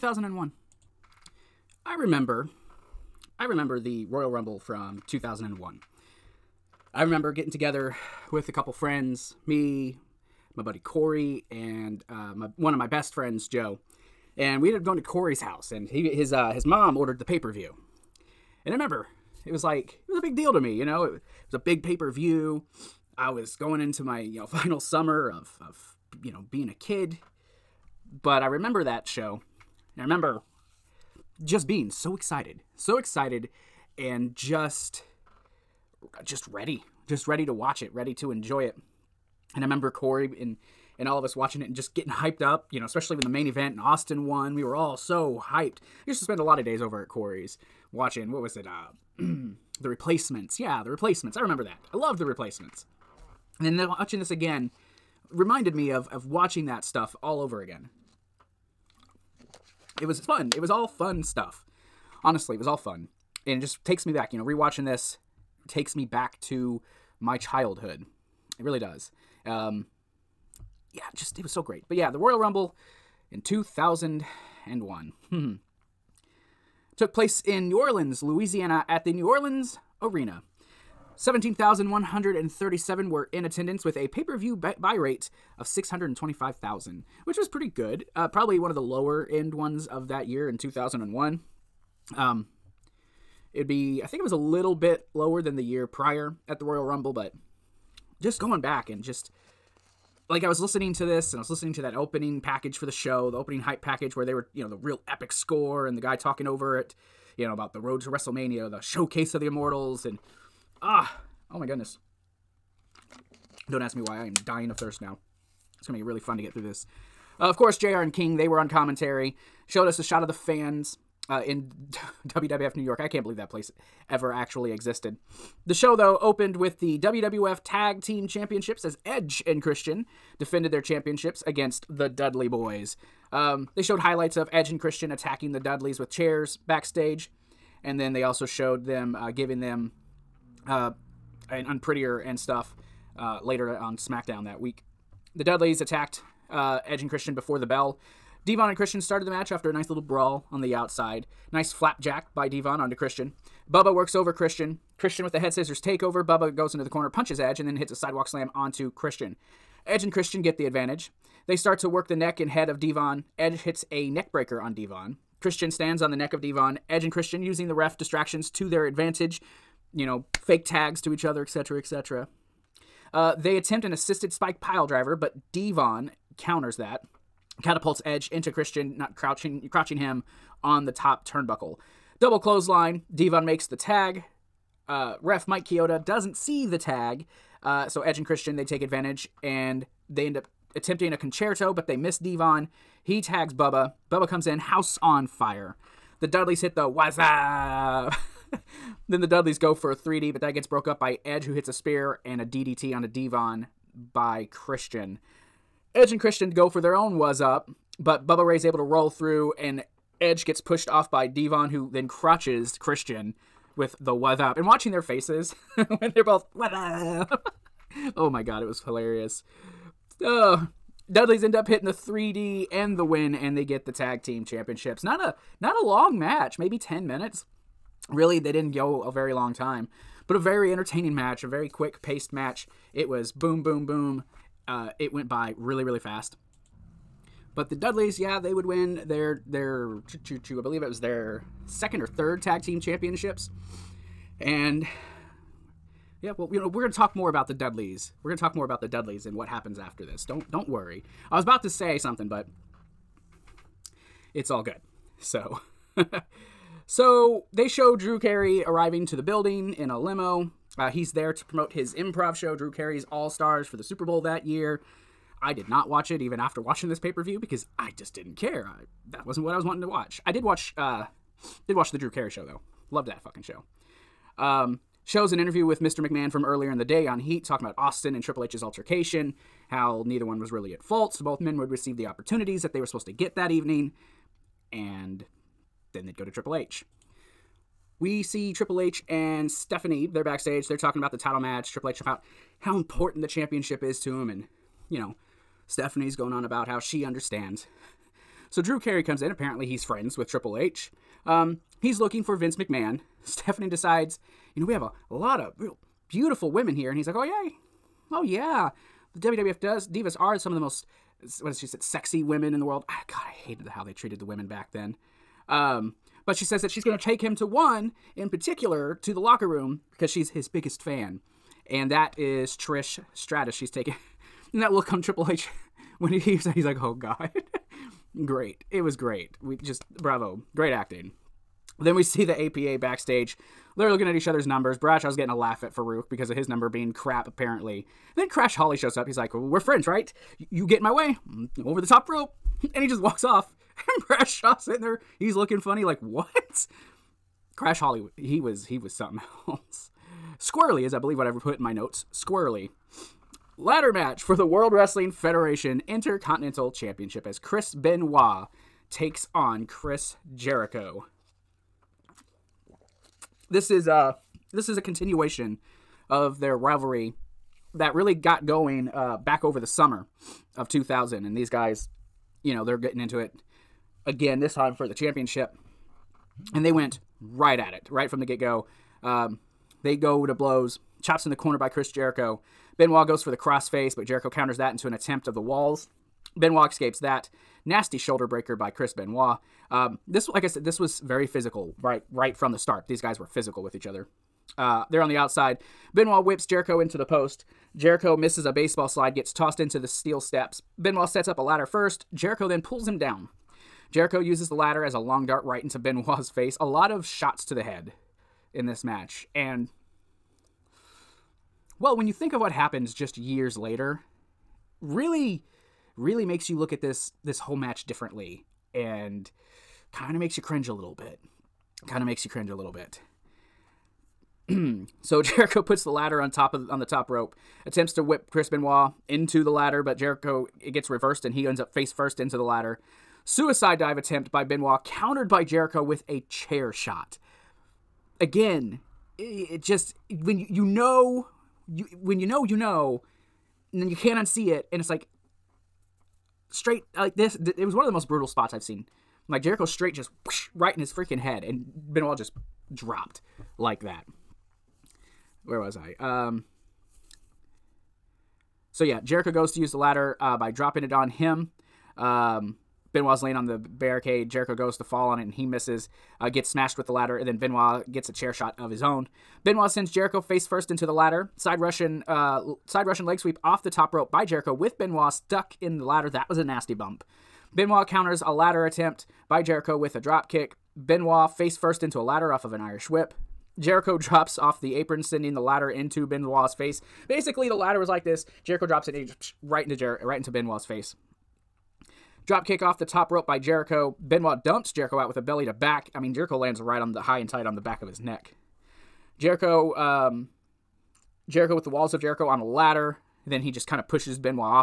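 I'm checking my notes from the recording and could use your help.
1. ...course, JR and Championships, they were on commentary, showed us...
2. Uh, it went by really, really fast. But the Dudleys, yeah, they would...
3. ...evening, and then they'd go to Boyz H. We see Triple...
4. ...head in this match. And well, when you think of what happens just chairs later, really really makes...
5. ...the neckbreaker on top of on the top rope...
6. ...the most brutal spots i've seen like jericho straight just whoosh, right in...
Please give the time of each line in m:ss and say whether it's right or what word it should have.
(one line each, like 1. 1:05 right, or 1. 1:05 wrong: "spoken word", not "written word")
1. 1:57 wrong: "King", not "Championships"
2. 3:54 right
3. 4:43 wrong: "Triple", not "Boyz"
4. 6:47 wrong: "years", not "chairs"
5. 7:05 wrong: "ladder", not "neckbreaker"
6. 7:27 right.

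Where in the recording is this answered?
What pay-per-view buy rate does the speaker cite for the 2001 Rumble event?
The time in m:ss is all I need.
1:25.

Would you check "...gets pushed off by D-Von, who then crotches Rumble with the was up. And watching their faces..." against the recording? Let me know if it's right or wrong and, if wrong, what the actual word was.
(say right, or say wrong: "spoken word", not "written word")
wrong: "Christian", not "Rumble".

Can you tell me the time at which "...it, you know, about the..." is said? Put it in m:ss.
1:46.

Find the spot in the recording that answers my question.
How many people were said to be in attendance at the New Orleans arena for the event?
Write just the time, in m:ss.
1:21.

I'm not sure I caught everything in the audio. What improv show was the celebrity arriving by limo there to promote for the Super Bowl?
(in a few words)
Drew Carey's All Stars.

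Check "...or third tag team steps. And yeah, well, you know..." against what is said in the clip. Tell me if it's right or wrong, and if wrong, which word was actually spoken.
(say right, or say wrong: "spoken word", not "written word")
wrong: "championships", not "steps".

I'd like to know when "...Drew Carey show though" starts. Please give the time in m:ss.
4:31.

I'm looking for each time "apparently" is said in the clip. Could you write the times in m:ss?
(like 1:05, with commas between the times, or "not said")
4:59, 5:37.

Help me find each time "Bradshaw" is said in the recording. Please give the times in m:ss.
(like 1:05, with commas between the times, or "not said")
5:34, 5:44.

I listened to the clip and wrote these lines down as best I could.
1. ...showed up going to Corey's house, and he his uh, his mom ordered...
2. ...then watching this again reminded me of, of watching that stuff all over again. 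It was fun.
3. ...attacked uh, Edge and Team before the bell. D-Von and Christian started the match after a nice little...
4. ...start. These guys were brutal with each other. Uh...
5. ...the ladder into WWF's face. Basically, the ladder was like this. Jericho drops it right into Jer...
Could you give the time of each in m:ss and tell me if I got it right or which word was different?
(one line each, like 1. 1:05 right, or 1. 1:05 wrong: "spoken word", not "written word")
1. 0:14 wrong: "ended", not "showed"
2. 0:53 right
3. 2:25 wrong: "Christian", not "Team"
4. 6:32 wrong: "physical", not "brutal"
5. 8:05 wrong: "Benoit", not "WWF".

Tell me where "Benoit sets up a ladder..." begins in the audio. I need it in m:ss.
6:40.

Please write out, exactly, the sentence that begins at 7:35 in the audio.
Um, so yeah, Jericho goes to use the ladder uh, by dropping it on him.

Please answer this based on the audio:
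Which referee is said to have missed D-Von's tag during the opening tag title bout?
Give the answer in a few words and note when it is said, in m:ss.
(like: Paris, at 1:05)
Mike Chioda, at 3:05.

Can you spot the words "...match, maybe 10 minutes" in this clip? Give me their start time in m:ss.
3:46.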